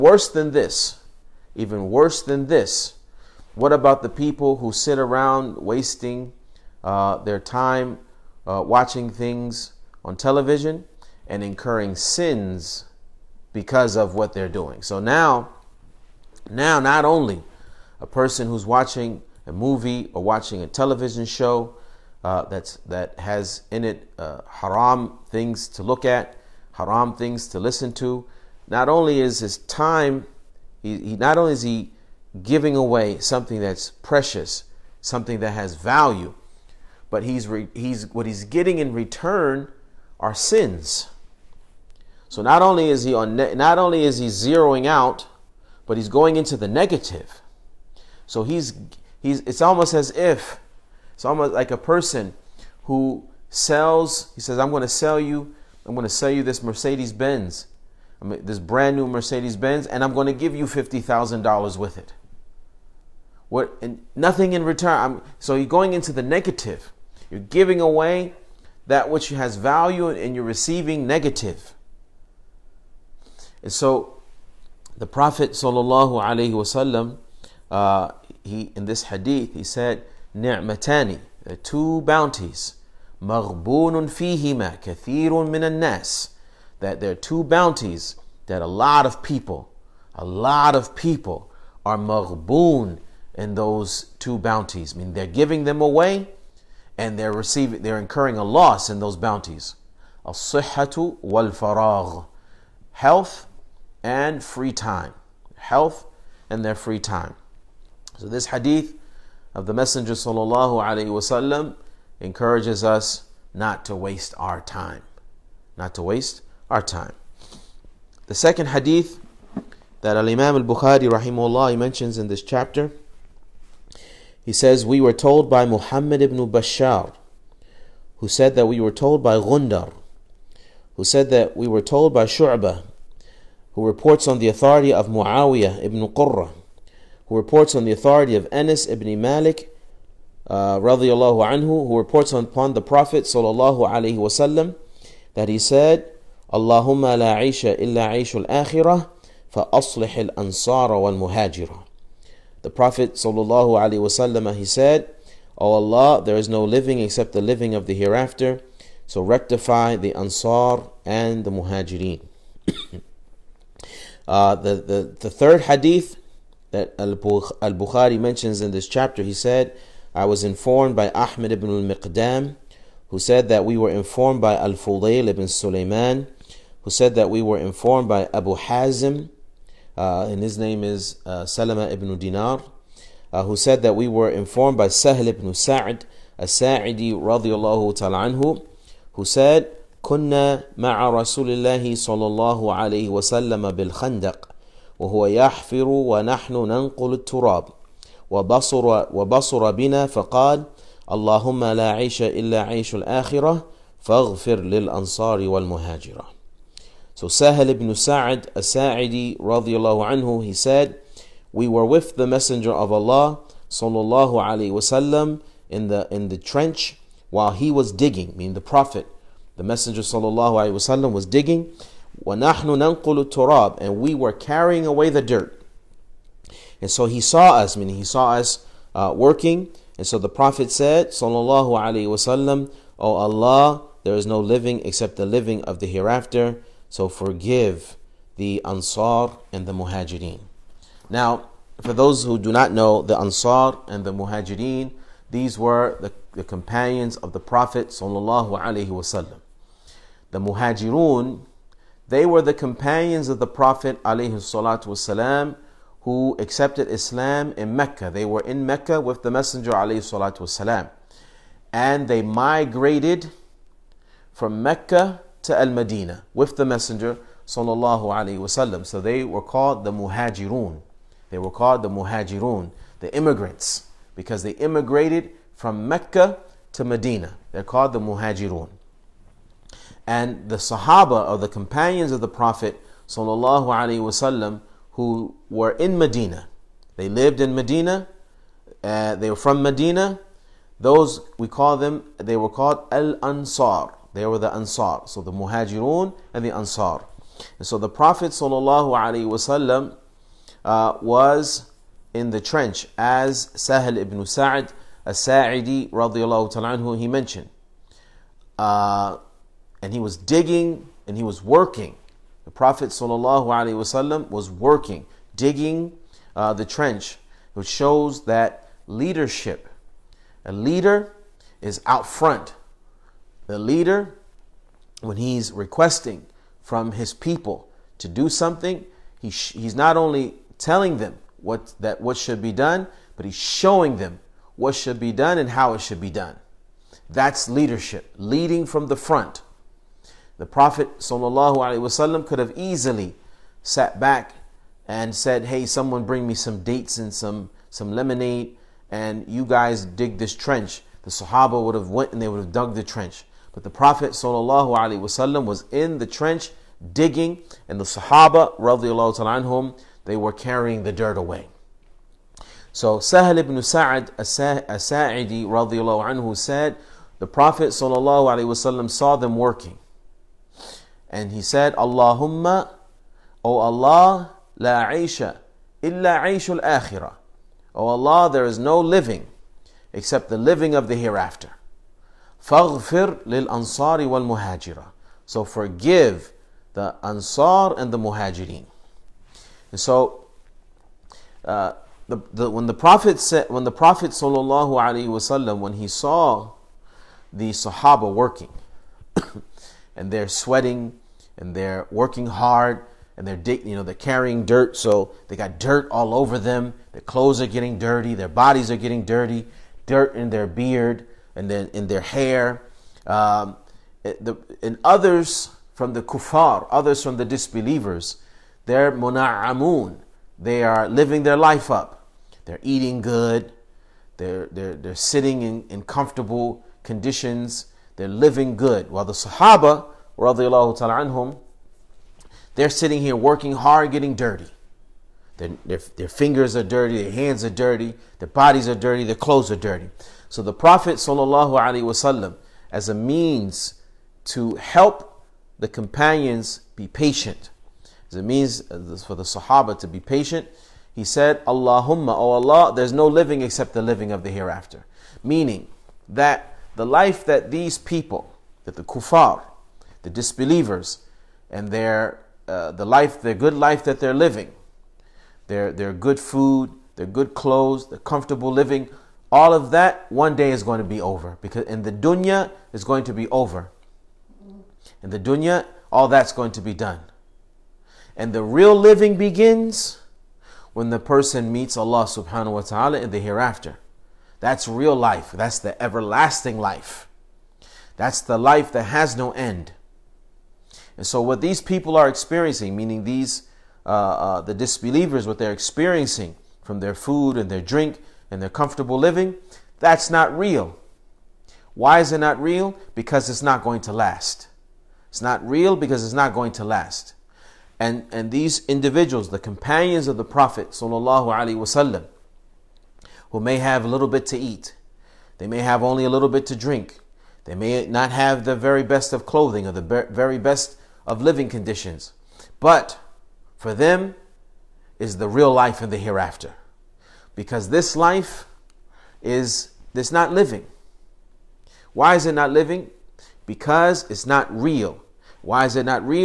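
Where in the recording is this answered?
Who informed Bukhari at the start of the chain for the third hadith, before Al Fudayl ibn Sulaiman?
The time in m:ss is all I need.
2:51.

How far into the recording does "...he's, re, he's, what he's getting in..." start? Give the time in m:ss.
0:37.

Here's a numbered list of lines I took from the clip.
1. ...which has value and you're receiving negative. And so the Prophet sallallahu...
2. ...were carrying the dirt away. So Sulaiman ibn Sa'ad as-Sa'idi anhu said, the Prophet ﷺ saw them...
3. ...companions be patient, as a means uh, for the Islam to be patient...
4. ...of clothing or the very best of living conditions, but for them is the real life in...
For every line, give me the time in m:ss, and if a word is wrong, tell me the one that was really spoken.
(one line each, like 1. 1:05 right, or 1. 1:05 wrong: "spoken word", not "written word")
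1. 1:09 right
2. 6:00 wrong: "Sahal", not "Sulaiman"
3. 7:25 wrong: "Sahaba", not "Islam"
4. 8:39 right.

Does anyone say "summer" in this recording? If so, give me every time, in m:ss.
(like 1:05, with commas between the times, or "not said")
not said.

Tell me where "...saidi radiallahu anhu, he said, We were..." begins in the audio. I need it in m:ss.
3:28.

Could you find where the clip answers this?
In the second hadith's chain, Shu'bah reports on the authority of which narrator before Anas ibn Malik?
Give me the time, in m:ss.
2:15.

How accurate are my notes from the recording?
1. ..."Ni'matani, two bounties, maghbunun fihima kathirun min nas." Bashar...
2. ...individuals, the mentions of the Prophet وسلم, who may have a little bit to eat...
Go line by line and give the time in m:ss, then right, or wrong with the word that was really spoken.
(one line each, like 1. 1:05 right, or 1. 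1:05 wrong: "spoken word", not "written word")
1. 1:20 wrong: "That", not "Bashar"
2. 8:28 wrong: "companions", not "mentions".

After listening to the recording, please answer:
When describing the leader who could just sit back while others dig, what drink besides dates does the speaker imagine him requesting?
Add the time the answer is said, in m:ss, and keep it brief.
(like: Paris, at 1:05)
lemonade, at 5:47.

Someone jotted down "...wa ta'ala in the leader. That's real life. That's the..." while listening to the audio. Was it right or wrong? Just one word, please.
wrong.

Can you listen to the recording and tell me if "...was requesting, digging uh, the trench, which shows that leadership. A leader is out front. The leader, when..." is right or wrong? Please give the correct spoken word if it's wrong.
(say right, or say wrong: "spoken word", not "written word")
wrong: "working", not "requesting".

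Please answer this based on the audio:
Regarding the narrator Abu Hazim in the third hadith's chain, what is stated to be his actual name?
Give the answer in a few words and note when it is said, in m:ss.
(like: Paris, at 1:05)
Salama ibn Dinar, at 3:01.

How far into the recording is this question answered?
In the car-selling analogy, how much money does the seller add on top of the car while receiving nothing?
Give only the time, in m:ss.
1:00.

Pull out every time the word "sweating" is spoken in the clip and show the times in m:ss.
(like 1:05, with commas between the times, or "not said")
6:40.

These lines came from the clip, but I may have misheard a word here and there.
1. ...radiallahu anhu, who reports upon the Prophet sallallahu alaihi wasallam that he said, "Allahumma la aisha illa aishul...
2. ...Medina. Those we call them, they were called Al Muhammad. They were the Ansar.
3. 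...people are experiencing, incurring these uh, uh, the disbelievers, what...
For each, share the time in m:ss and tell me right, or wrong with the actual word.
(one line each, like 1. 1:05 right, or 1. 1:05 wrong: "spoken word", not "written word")
1. 2:20 right
2. 4:49 wrong: "Ansar", not "Muhammad"
3. 8:11 wrong: "meaning", not "incurring".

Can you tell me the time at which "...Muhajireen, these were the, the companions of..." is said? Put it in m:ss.
4:04.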